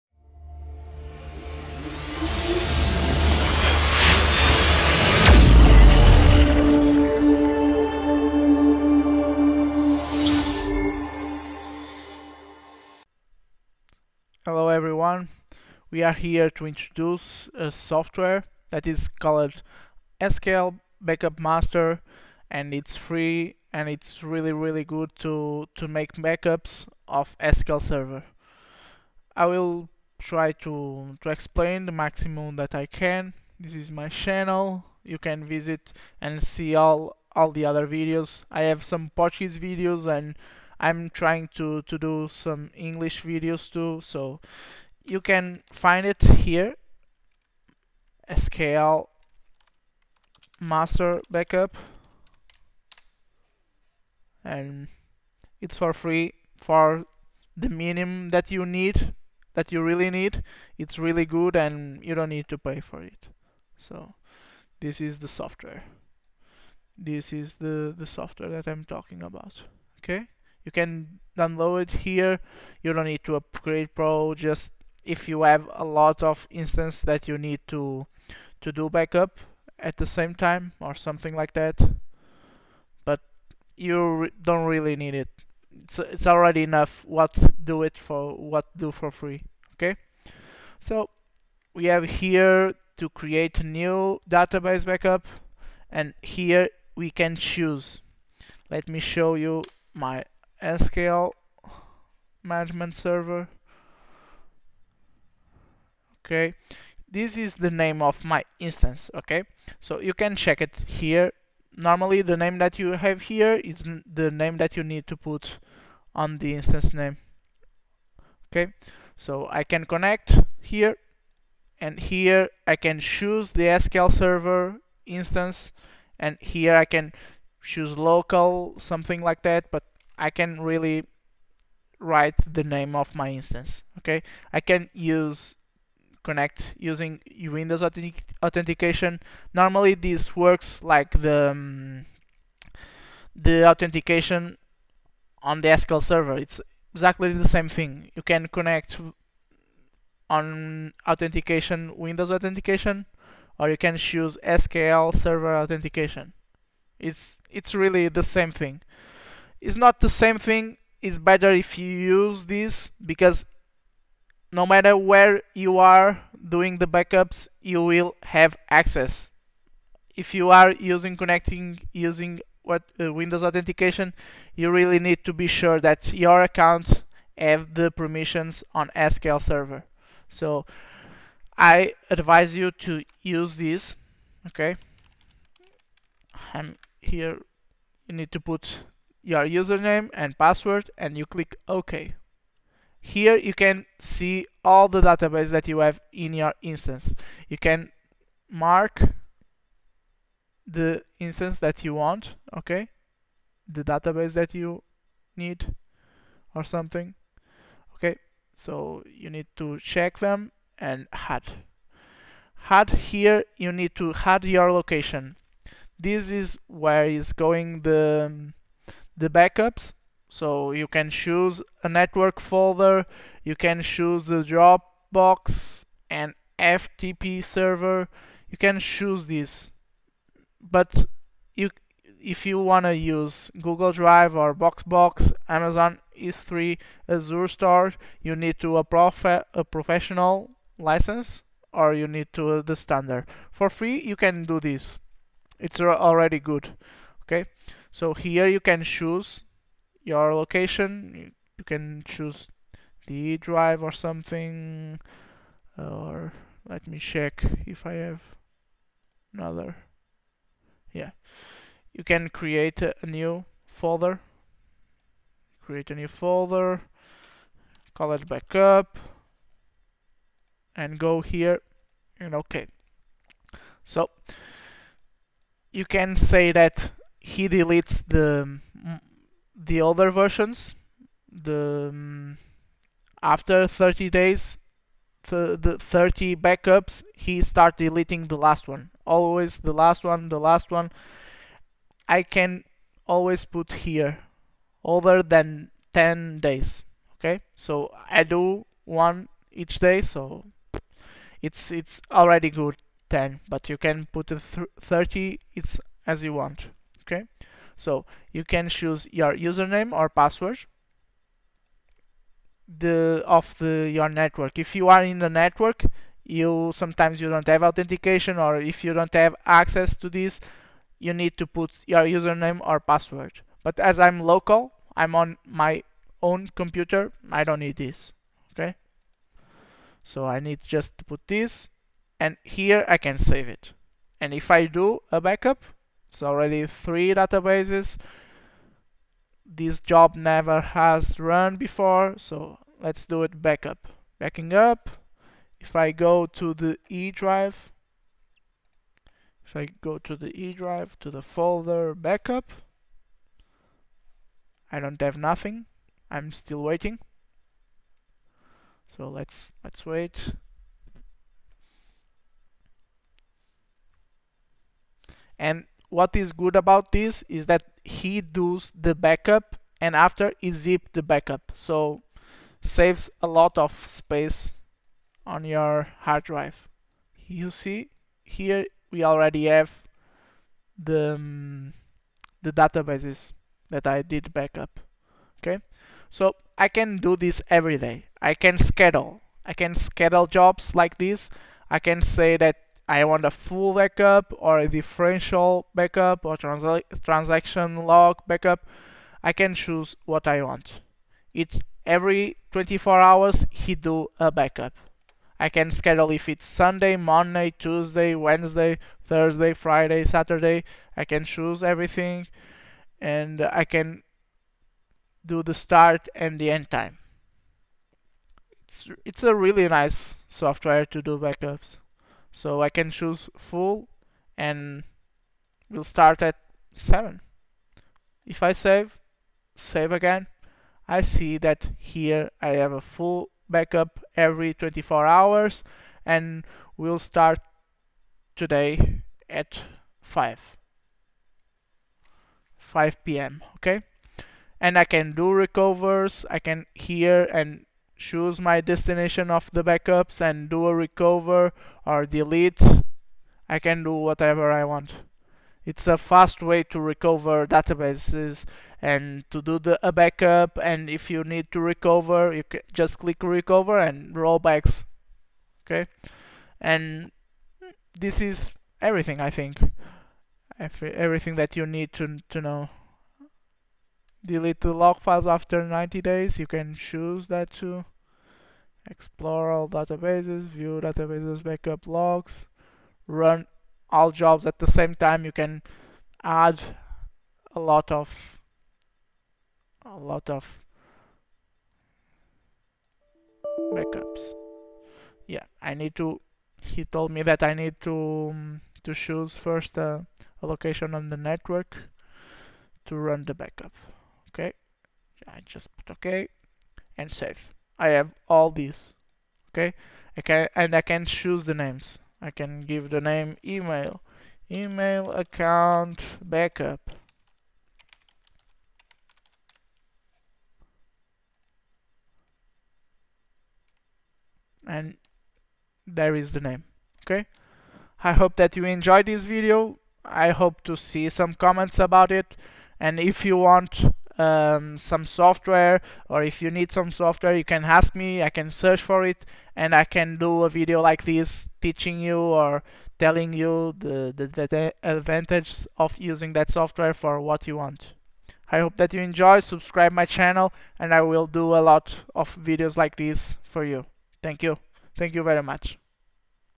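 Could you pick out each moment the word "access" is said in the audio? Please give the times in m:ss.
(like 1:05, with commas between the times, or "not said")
2:48, 5:19.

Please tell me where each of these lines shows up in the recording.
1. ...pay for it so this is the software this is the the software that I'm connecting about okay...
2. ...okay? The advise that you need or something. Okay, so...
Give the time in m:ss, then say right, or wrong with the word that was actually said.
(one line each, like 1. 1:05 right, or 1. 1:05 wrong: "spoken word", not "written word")
1. 1:02 wrong: "talking", not "connecting"
2. 3:22 wrong: "database", not "advise".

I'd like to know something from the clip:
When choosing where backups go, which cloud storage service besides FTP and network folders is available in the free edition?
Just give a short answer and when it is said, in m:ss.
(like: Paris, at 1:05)
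Dropbox, at 3:44.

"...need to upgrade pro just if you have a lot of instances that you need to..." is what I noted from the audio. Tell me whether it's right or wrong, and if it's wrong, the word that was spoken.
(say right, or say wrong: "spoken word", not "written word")
right.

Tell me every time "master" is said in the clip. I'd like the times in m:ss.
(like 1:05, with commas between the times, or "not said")
0:21, 0:50.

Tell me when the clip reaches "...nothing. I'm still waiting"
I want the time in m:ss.
5:55.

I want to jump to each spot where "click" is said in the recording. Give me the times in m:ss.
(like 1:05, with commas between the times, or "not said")
3:11, 7:42.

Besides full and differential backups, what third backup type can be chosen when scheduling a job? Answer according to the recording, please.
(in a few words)
Transaction log.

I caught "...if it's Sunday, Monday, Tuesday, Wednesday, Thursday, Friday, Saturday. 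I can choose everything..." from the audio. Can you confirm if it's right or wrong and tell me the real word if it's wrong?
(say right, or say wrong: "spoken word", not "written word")
right.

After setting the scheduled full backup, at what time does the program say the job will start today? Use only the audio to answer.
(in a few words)
5 p.m.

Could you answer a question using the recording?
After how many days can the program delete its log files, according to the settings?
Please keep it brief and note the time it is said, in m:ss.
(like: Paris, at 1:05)
90, at 7:55.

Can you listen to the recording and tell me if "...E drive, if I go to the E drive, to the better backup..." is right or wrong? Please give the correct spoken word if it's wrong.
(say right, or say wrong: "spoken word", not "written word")
wrong: "folder", not "better".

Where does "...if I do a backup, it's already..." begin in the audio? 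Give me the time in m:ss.
5:34.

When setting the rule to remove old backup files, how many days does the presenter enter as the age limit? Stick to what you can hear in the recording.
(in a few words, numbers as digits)
10.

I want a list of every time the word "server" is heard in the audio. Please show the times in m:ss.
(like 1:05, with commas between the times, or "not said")
0:27, 1:42, 2:04, 2:26, 2:35, 2:59, 3:47.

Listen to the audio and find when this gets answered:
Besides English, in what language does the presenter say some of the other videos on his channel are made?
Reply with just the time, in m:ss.
0:39.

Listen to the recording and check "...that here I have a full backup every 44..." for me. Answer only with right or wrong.
wrong.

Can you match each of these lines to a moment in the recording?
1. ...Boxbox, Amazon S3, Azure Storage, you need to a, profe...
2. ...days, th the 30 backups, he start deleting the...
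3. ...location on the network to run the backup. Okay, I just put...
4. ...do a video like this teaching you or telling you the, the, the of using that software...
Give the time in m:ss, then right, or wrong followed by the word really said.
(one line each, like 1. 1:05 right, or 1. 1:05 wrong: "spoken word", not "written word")
1. 3:54 right
2. 4:44 right
3. 8:20 right
4. 9:00 right.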